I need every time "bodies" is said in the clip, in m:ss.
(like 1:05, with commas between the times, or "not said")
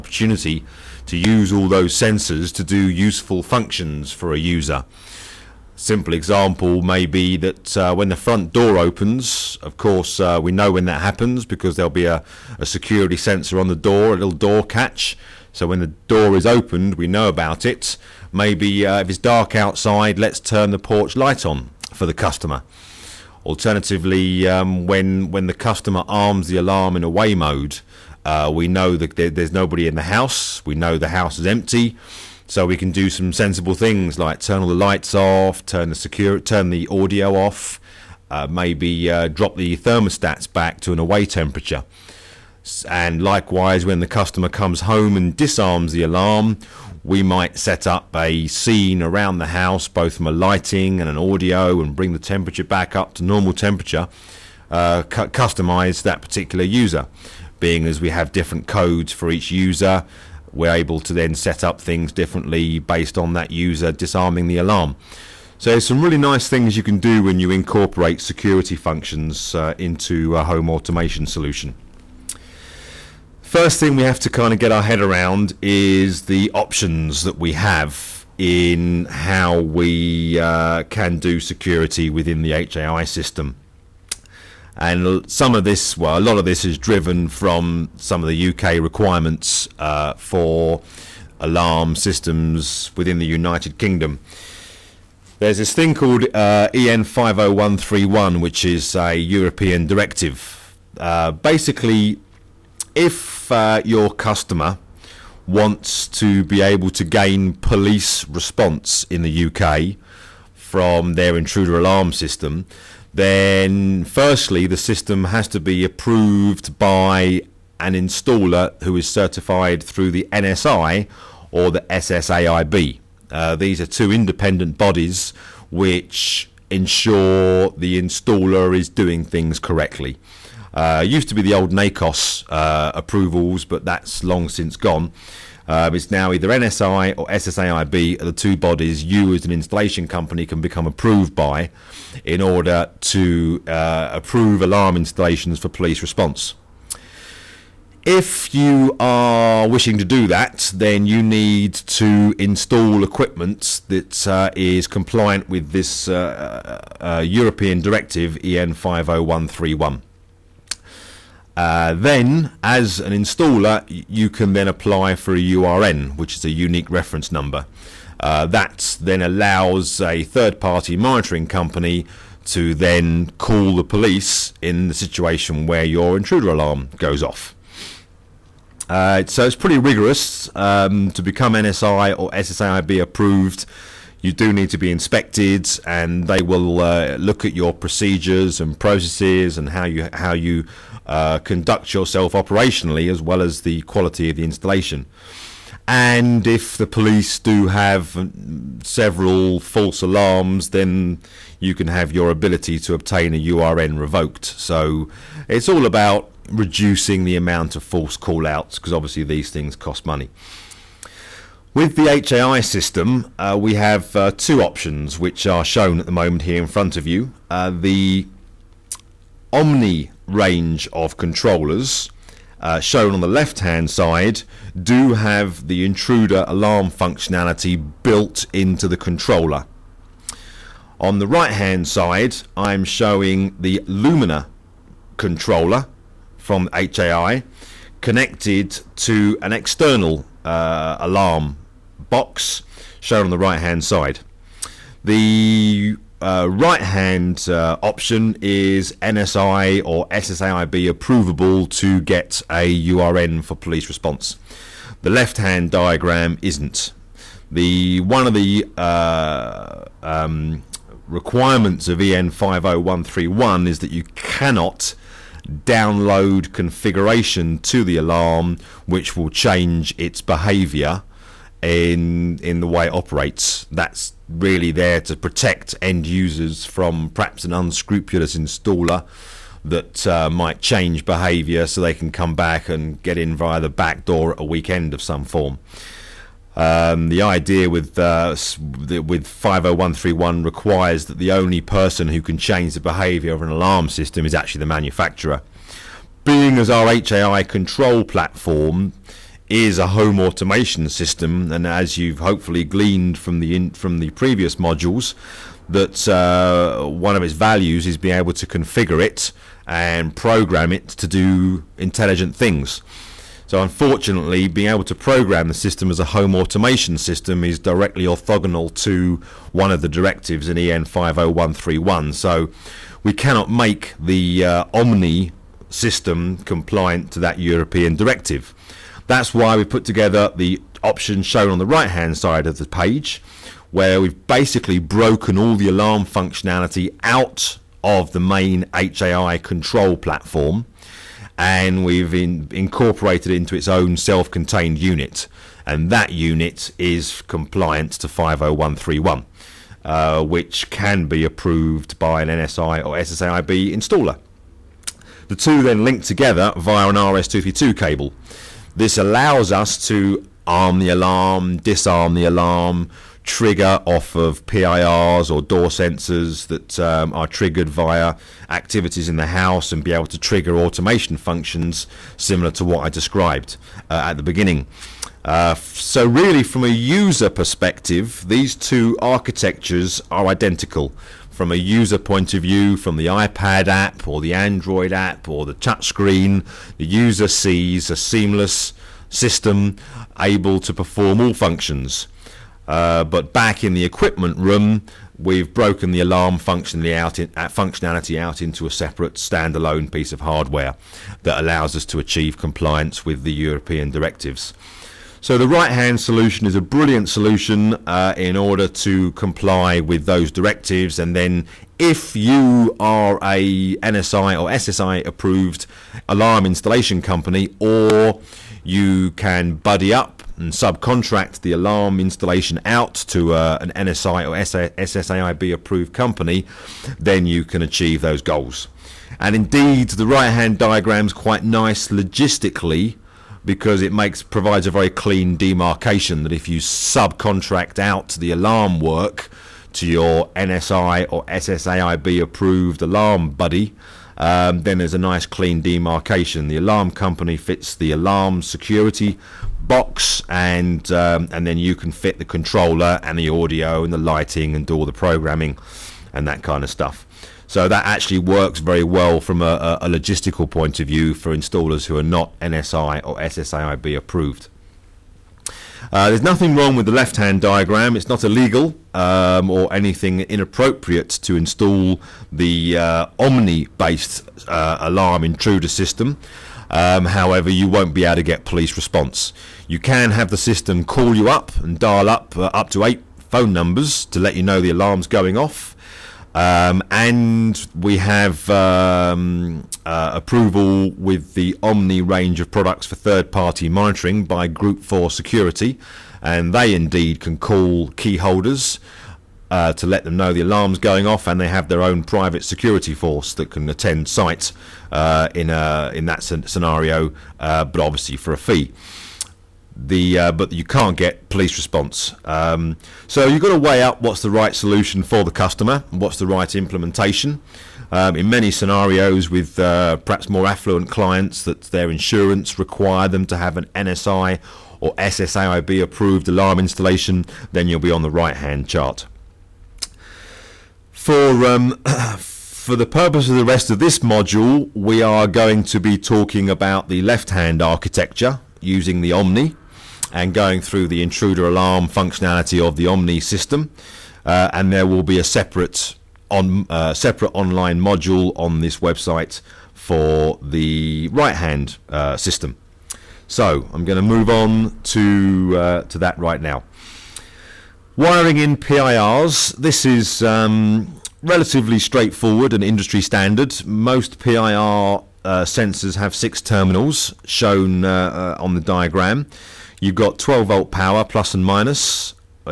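2:04, 2:18.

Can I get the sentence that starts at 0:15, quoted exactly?
So when the door is opened, we know about it.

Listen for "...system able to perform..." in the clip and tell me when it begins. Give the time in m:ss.
6:29.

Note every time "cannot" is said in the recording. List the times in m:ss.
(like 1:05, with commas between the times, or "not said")
4:24, 5:23.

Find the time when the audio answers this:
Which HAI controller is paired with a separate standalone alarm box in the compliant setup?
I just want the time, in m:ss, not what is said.
3:53.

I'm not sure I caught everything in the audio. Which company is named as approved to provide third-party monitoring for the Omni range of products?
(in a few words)
Group 4 Security.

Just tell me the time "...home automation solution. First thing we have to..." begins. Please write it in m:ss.
1:10.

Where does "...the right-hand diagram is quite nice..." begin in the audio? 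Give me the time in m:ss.
7:09.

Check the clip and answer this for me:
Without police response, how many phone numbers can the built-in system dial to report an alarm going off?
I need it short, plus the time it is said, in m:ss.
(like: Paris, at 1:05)
8, at 8:02.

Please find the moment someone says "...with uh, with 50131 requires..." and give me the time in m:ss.
4:47.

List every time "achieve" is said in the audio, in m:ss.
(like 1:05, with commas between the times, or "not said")
6:41, 7:07.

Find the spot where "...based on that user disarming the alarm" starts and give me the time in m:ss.
1:02.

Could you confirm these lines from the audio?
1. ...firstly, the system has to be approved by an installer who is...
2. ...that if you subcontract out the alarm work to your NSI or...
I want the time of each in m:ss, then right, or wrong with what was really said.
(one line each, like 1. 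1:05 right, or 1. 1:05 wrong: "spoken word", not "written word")
1. 1:54 right
2. 7:16 right.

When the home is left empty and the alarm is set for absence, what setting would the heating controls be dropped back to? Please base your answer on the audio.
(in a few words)
away temperature.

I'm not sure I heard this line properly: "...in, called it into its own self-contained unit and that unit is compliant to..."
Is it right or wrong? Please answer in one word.
wrong.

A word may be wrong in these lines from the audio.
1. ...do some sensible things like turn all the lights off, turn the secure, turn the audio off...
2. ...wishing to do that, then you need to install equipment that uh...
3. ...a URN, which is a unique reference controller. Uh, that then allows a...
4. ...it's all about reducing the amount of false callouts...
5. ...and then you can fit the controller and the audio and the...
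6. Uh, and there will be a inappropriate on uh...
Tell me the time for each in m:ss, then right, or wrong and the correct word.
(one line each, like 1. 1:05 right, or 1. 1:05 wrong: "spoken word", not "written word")
1. 0:32 right
2. 2:29 right
3. 2:45 wrong: "number", not "controller"
4. 3:25 right
5. 7:31 right
6. 9:04 wrong: "separate", not "inappropriate".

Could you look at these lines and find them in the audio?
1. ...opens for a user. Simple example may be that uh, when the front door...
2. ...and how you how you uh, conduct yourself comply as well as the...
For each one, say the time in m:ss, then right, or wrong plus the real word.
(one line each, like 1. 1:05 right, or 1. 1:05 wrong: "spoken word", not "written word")
1. 0:03 wrong: "functions", not "opens"
2. 3:09 wrong: "operationally", not "comply".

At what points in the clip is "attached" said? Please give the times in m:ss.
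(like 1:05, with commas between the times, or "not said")
not said.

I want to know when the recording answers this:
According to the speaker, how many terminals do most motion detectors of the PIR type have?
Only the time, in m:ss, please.
9:26.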